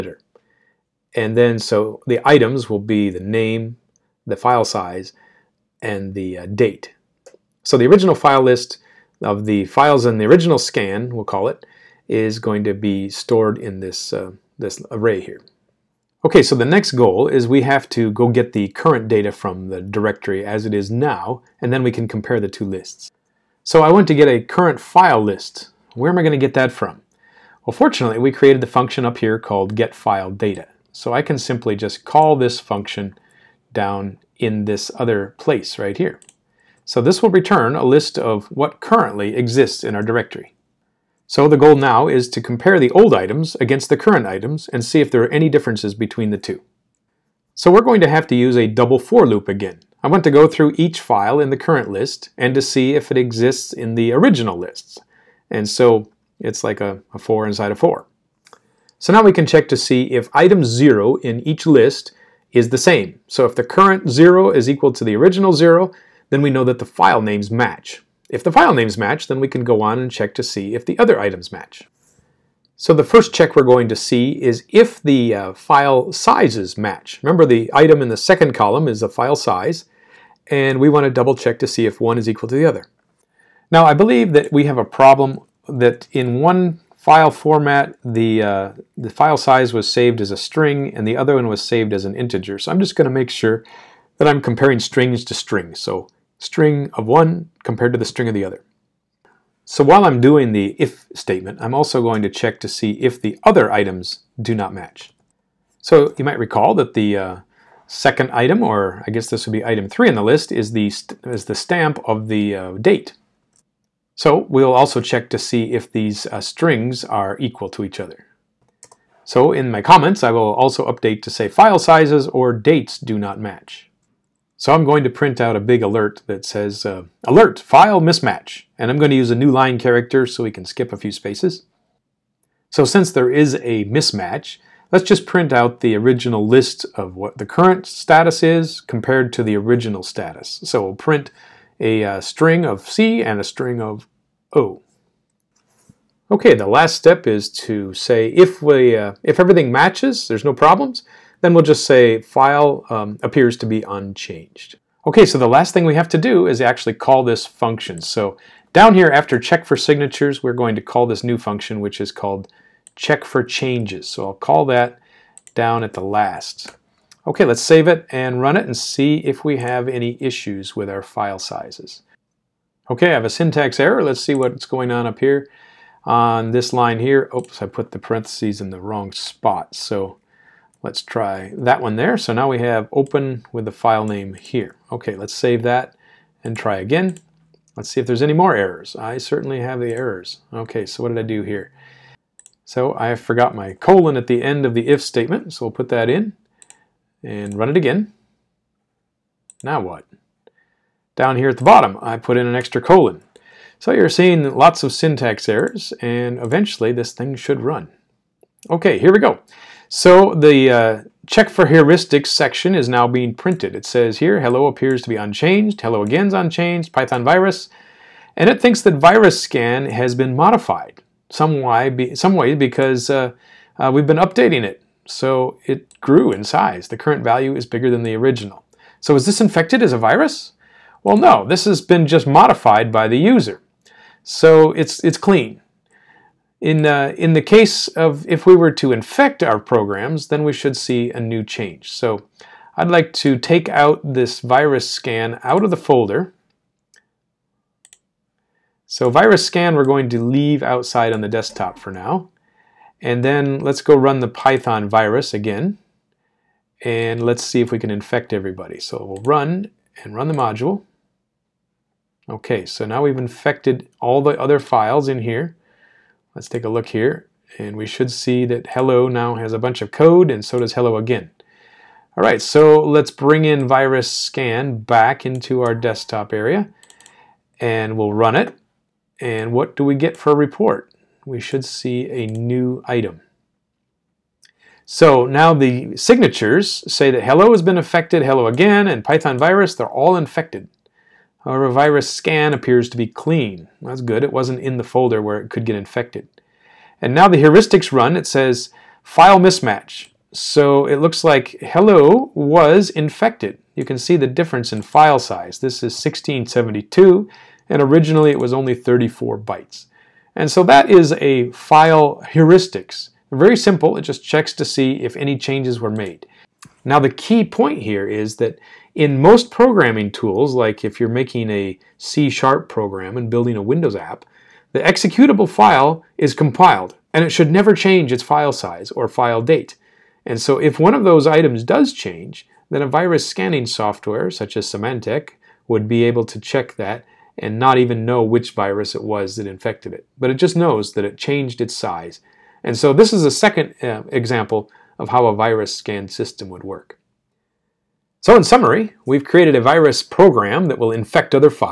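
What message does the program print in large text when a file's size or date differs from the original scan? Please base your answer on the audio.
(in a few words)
alert, file mismatch.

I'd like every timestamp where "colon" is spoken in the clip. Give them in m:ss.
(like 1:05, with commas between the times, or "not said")
3:13, 3:22.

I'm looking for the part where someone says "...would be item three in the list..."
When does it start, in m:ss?
1:49.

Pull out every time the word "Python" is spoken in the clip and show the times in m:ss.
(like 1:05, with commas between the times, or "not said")
3:36, 4:14, 4:49.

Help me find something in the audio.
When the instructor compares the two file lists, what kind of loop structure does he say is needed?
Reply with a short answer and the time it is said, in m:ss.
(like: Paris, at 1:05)
double for loop, at 0:48.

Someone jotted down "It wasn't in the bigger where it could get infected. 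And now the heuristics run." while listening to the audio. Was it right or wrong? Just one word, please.
wrong.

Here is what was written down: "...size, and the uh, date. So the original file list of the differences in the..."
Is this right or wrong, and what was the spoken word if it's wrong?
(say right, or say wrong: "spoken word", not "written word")
wrong: "files", not "differences".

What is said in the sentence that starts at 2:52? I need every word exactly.
Okay, I have a syntax error.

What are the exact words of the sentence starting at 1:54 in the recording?
So we'll also check to see if these uh, strings are equal to each other.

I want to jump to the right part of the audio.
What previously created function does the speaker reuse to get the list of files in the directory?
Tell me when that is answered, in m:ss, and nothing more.
0:29.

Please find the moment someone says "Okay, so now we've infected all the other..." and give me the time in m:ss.
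4:22.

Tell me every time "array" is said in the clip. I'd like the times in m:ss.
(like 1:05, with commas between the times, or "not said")
0:14.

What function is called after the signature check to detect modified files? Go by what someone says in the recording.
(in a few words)
check for changes.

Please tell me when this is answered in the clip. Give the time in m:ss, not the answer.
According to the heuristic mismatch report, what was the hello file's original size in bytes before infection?
5:08.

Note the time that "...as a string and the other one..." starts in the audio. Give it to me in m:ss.
1:30.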